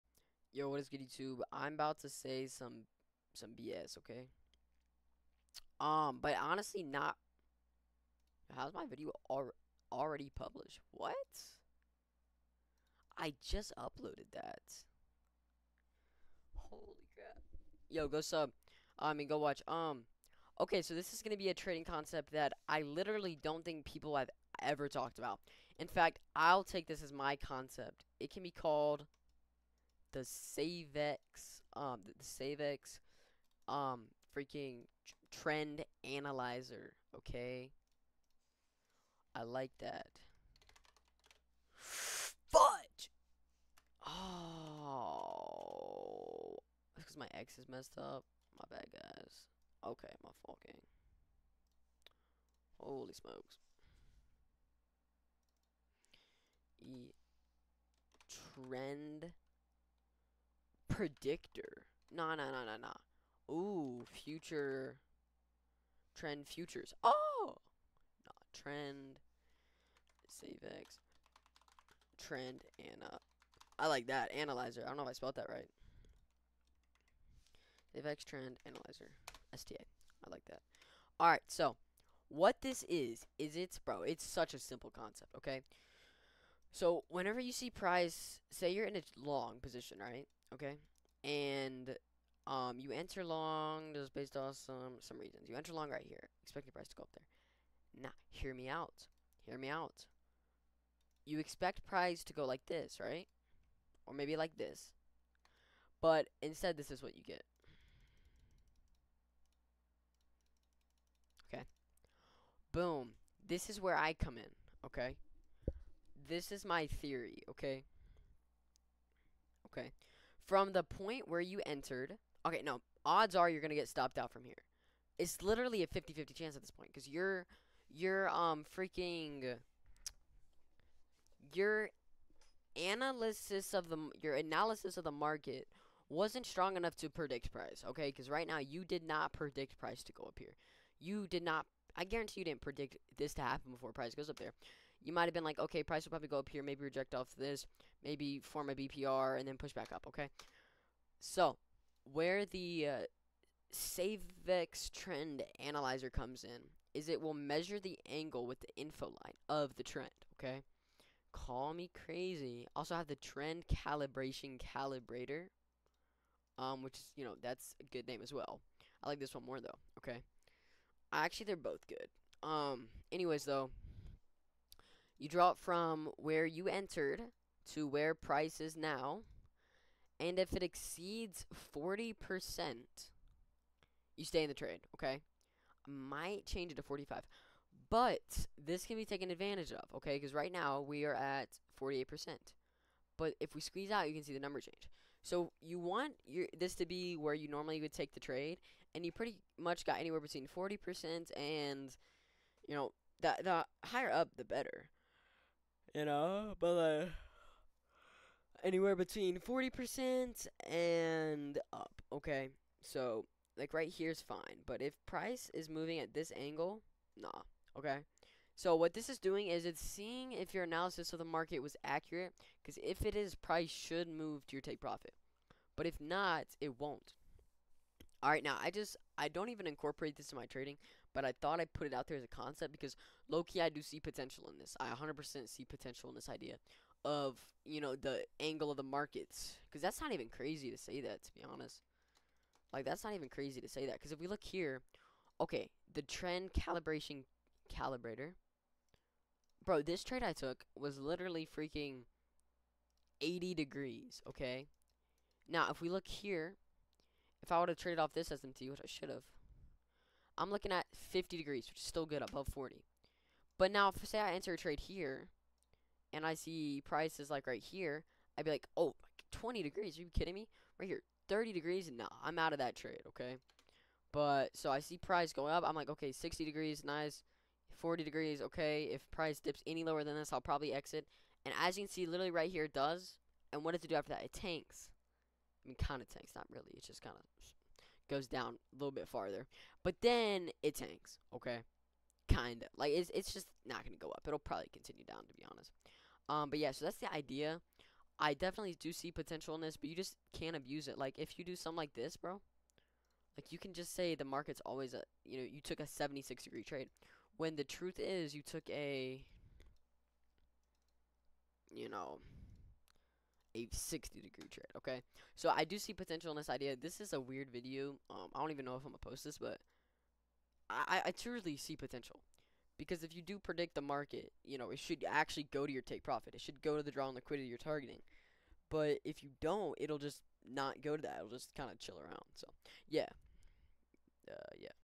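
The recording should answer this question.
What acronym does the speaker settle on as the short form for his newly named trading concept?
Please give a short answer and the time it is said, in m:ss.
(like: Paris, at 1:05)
STA, at 1:19.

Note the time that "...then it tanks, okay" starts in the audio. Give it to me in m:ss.
4:50.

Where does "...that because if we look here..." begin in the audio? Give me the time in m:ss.
4:03.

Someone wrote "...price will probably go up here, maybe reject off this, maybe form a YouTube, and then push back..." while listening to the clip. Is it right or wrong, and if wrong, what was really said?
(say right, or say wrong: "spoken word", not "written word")
wrong: "BPR", not "YouTube".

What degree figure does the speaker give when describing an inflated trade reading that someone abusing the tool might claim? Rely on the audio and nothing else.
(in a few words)
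76.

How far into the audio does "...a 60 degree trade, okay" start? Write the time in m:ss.
5:13.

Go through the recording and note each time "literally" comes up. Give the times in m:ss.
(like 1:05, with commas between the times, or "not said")
0:22, 2:05, 4:10, 4:42.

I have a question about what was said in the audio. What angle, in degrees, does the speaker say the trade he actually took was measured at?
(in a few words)
80 degrees.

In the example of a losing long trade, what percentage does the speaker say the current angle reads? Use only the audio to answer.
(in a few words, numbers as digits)
48%.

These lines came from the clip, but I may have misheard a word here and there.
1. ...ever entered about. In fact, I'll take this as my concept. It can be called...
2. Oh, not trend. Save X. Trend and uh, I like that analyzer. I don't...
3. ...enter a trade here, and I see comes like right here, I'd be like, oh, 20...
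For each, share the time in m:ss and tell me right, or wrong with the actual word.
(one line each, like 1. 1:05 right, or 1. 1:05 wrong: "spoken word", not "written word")
1. 0:24 wrong: "talked", not "entered"
2. 1:07 right
3. 4:24 wrong: "prices", not "comes".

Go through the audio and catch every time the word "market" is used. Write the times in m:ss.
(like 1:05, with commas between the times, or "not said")
2:15, 3:41, 3:58, 5:04, 5:23.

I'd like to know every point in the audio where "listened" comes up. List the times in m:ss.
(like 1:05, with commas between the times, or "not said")
not said.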